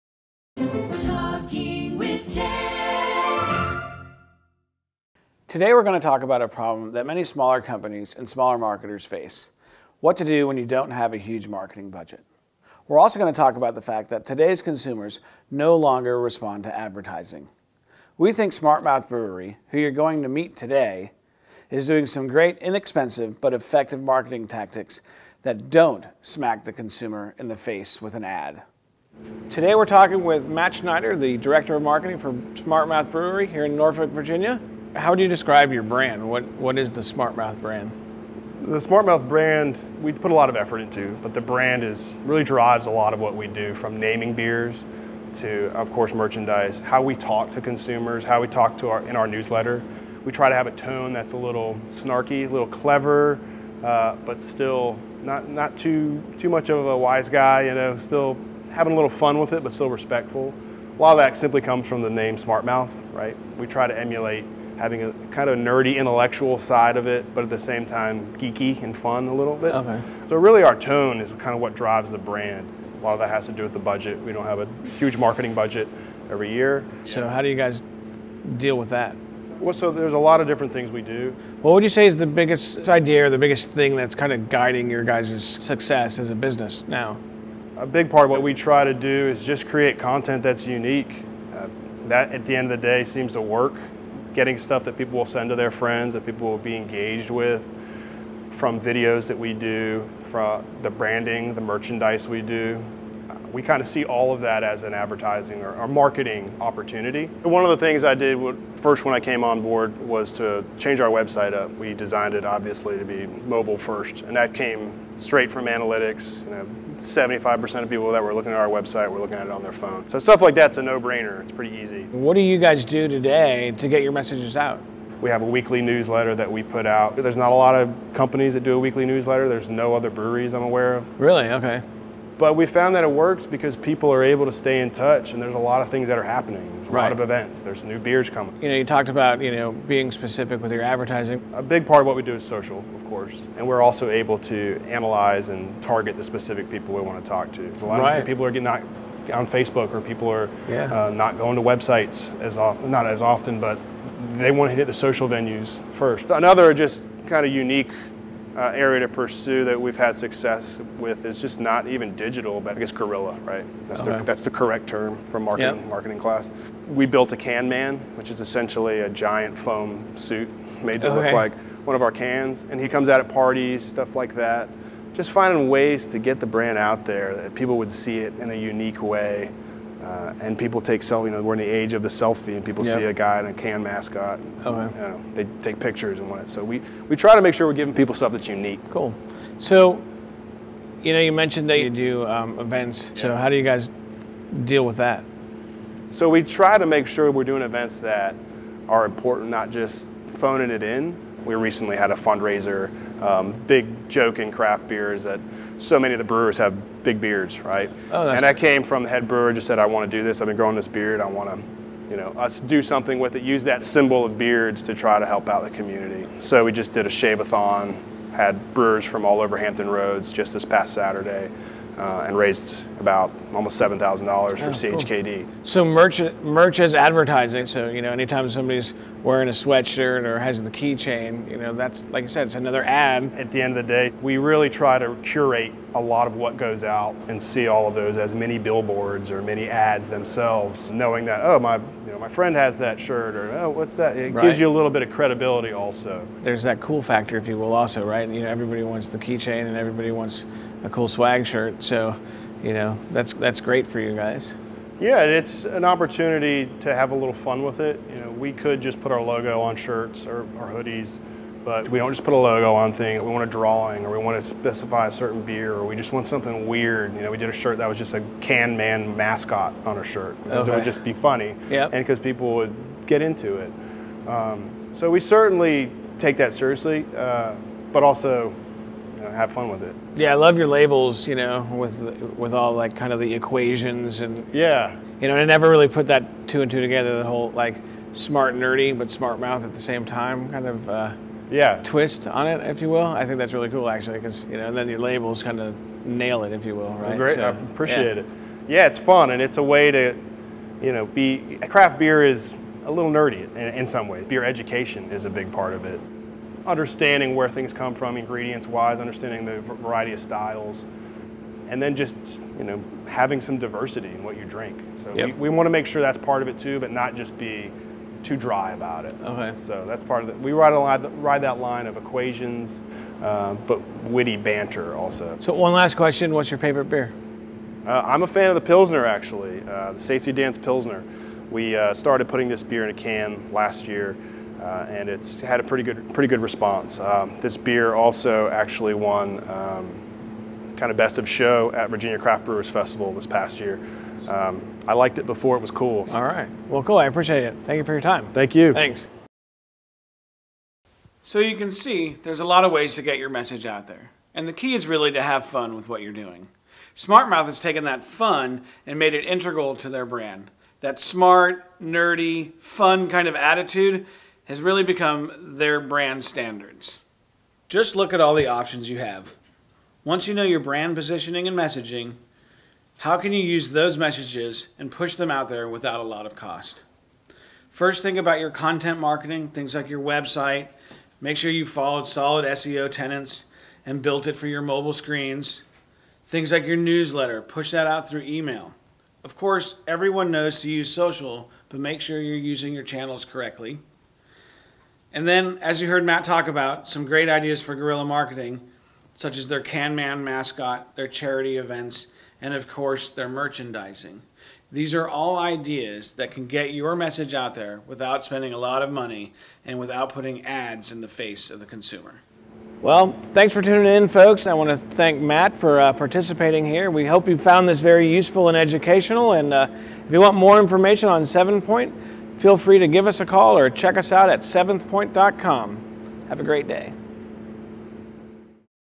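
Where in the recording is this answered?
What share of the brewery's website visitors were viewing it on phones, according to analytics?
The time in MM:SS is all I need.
01:57.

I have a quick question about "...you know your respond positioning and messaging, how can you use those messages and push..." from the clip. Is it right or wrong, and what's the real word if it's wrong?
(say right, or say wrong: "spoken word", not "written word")
wrong: "brand", not "respond".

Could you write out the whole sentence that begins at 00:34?
How would you describe your brand?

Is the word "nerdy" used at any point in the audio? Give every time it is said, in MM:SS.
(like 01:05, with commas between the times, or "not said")
01:05, 04:48, 05:03, 06:01.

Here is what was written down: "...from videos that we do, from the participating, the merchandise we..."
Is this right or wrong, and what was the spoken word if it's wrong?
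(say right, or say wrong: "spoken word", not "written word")
wrong: "branding", not "participating".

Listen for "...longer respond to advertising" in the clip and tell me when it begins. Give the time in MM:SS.
00:15.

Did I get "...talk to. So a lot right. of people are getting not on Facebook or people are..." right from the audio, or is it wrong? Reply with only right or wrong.
right.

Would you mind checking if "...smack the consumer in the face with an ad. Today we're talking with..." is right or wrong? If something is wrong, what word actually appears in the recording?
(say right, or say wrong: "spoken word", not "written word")
right.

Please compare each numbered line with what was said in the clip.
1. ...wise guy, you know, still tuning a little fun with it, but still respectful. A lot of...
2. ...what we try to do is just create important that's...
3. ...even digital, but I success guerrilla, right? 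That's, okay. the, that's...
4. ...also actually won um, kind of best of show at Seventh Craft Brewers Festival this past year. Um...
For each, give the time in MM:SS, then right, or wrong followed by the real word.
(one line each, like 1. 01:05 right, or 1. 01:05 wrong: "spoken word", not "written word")
1. 00:56 wrong: "having", not "tuning"
2. 01:28 wrong: "content", not "important"
3. 02:41 wrong: "guess", not "success"
4. 05:37 wrong: "Virginia", not "Seventh".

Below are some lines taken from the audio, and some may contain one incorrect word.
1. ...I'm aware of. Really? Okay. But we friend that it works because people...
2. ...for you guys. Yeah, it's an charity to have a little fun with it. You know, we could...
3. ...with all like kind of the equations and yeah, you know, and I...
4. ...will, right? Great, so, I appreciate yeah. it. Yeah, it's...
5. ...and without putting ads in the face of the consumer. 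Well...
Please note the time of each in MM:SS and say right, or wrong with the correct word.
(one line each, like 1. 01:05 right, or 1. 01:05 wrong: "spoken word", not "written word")
1. 02:10 wrong: "found", not "friend"
2. 04:13 wrong: "opportunity", not "charity"
3. 04:42 right
4. 04:56 right
5. 06:49 right.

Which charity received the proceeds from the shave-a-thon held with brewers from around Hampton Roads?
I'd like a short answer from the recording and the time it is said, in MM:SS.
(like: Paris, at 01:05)
CHKD, at 03:44.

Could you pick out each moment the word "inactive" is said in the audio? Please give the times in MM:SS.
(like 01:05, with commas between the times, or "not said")
not said.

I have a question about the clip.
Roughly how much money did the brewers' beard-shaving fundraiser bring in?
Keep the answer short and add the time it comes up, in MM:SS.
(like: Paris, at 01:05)
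almost $7,000, at 03:43.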